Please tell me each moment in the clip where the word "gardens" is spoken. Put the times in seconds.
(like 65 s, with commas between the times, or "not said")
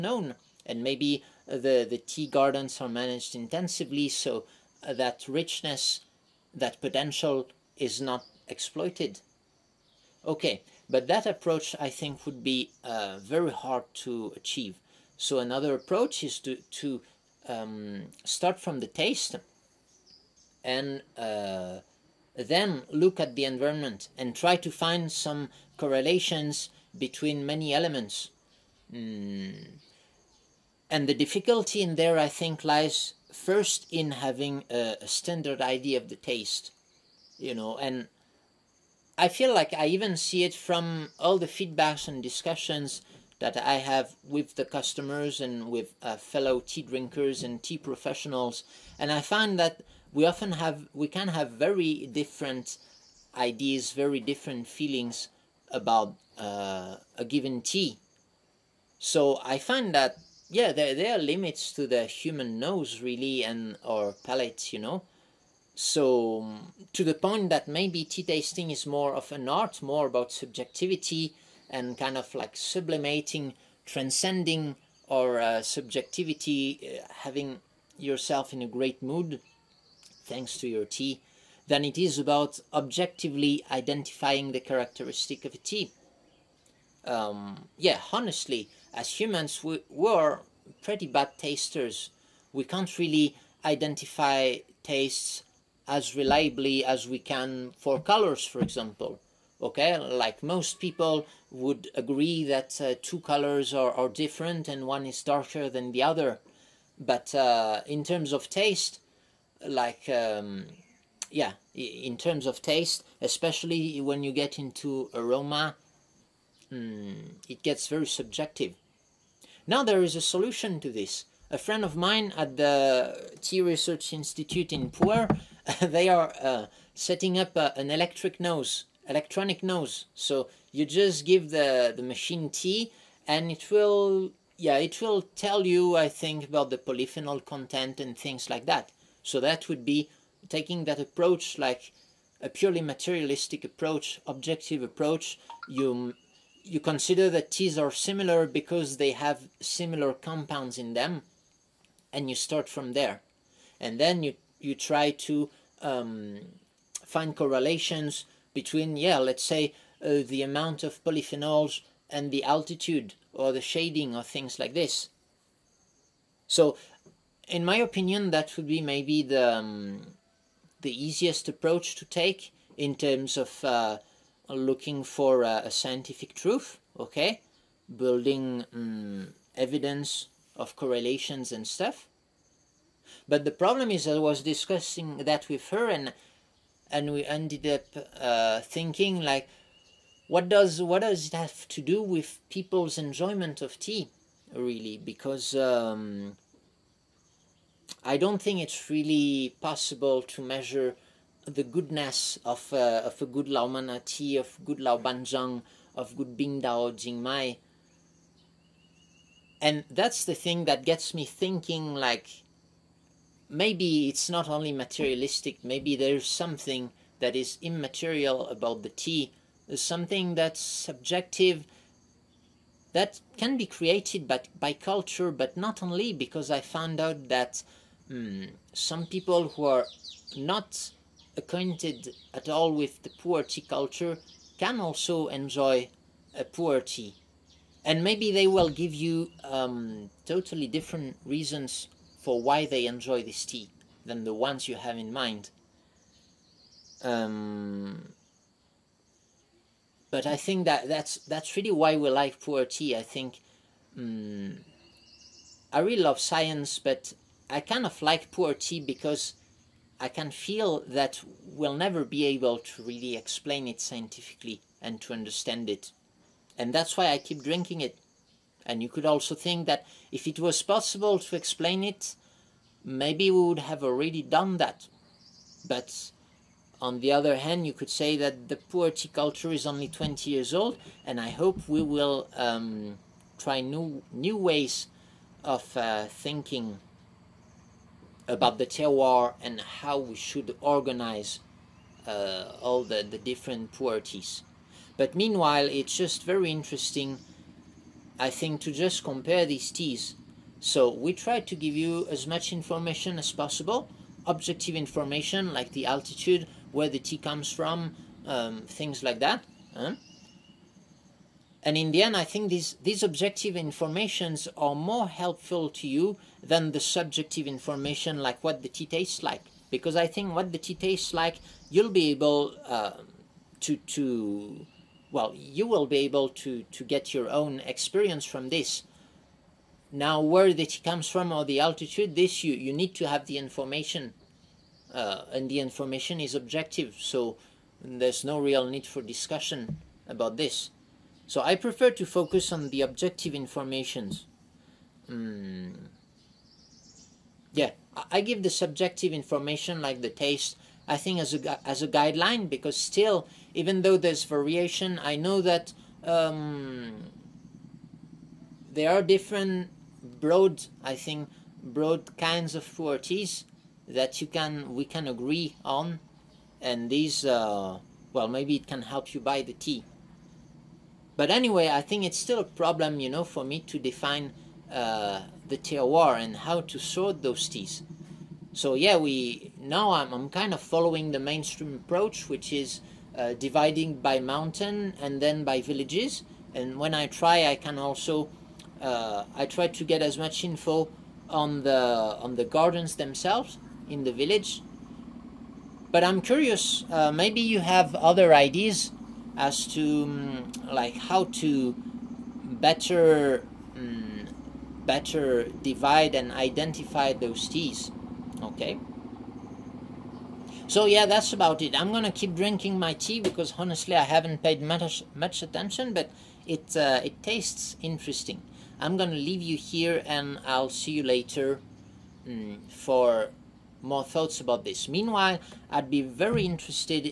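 2 s, 392 s.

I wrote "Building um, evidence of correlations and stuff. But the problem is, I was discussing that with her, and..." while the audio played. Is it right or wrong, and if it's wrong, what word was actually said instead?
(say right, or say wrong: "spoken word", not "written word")
right.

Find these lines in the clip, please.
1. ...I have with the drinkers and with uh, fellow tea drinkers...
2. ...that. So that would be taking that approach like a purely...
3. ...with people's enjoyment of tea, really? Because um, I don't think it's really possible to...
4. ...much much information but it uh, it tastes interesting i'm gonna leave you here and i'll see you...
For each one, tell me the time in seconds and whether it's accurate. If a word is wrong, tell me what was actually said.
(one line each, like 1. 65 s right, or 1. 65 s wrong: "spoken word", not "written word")
1. 43 s wrong: "customers", not "drinkers"
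2. 138 s right
3. 192 s right
4. 414 s wrong: "attention", not "information".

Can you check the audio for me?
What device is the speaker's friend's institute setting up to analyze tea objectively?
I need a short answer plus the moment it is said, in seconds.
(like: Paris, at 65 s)
electronic nose, at 129 s.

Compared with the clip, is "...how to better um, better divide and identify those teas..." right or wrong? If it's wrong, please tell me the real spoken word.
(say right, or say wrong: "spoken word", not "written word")
right.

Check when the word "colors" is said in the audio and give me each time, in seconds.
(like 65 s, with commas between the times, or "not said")
97 s, 103 s.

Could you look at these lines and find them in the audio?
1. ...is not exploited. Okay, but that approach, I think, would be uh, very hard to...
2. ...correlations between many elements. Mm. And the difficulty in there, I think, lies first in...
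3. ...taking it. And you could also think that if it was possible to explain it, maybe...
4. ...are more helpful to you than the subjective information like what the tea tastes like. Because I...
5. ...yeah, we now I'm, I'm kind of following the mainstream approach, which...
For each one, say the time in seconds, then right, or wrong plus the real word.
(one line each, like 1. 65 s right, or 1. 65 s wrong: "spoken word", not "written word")
1. 7 s right
2. 25 s right
3. 267 s wrong: "drinking", not "taking"
4. 314 s right
5. 378 s right.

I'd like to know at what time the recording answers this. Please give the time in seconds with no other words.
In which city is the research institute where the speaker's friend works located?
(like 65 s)
124 s.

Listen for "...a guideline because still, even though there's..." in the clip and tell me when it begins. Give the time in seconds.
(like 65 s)
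351 s.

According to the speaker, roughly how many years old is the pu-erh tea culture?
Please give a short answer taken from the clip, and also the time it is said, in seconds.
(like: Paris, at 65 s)
20 years, at 279 s.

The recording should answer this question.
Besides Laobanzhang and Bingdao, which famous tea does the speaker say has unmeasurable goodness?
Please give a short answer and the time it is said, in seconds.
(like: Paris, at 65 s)
Laomane, at 203 s.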